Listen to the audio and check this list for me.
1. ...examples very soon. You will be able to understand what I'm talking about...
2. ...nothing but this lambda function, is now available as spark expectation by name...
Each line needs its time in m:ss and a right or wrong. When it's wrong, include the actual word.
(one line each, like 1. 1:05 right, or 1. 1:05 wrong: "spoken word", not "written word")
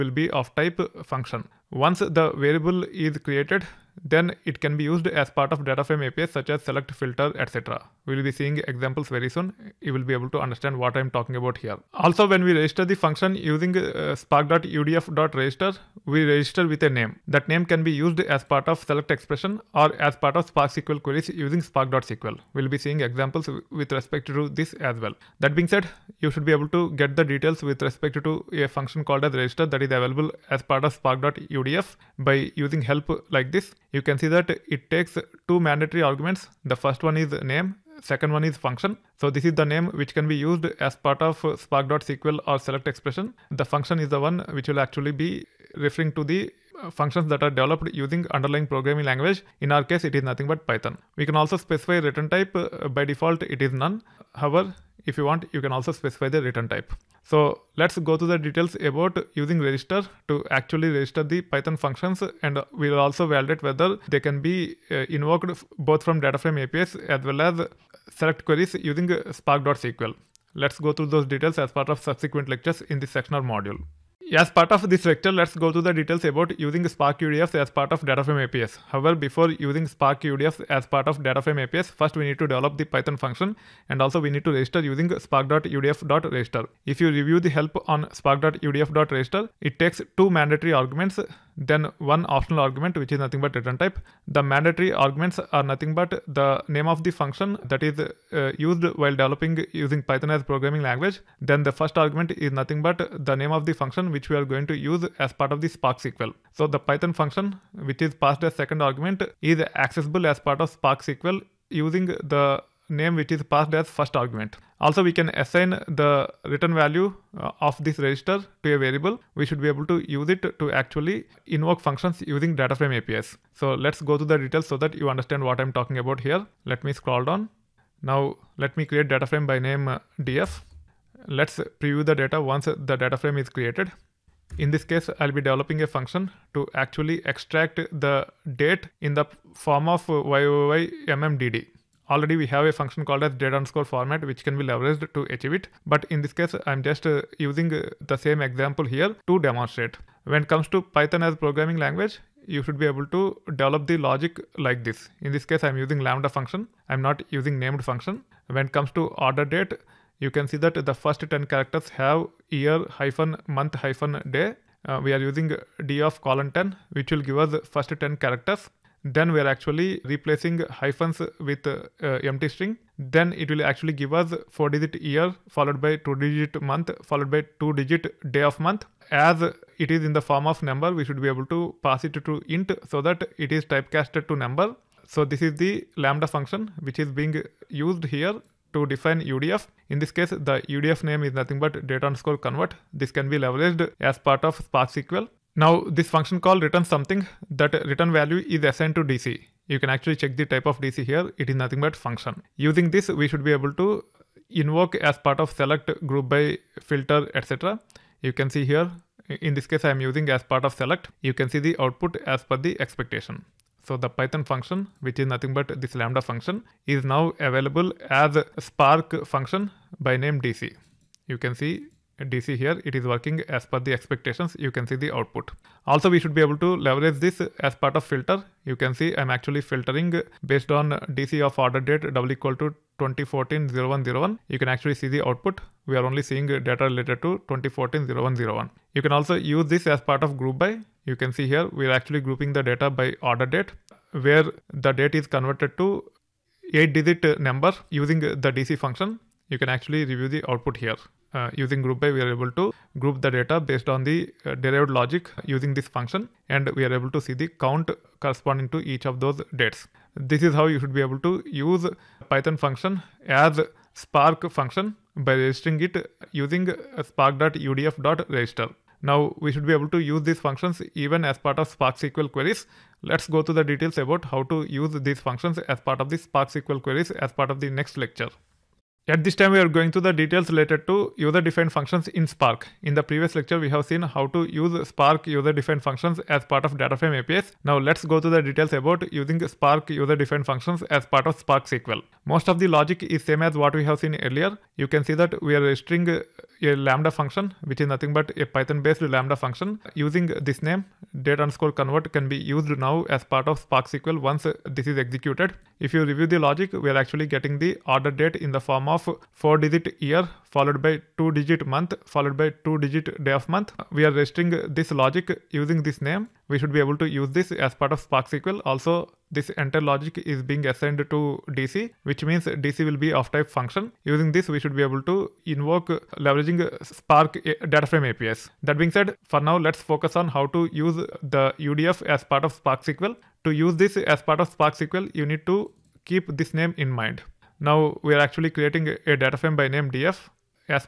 1. 0:08 right
2. 3:35 wrong: "function", not "expectation".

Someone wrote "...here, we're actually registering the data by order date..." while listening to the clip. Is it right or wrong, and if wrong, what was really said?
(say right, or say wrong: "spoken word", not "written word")
wrong: "grouping", not "registering".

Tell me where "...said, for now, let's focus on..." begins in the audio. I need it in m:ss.
5:28.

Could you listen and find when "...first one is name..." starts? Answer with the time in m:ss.
0:36.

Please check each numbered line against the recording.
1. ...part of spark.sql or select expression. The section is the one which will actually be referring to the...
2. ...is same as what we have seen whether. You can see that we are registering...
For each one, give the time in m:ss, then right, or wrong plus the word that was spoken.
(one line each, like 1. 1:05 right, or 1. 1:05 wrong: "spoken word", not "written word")
1. 0:40 wrong: "function", not "section"
2. 4:53 wrong: "earlier", not "whether".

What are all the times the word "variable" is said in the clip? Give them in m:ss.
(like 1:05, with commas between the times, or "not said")
0:02, 1:58.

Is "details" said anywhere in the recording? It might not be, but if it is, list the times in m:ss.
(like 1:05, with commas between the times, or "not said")
0:27, 0:58, 1:11, 1:15, 2:04, 4:33, 4:40, 4:48.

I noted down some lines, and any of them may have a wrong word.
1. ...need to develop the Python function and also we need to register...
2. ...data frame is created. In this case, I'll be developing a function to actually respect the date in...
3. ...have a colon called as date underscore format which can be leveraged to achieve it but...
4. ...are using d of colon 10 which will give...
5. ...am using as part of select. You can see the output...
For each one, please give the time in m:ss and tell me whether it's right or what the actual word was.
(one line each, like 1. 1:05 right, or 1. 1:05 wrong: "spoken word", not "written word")
1. 1:22 right
2. 2:12 wrong: "extract", not "respect"
3. 2:22 wrong: "function", not "colon"
4. 2:45 right
5. 3:29 right.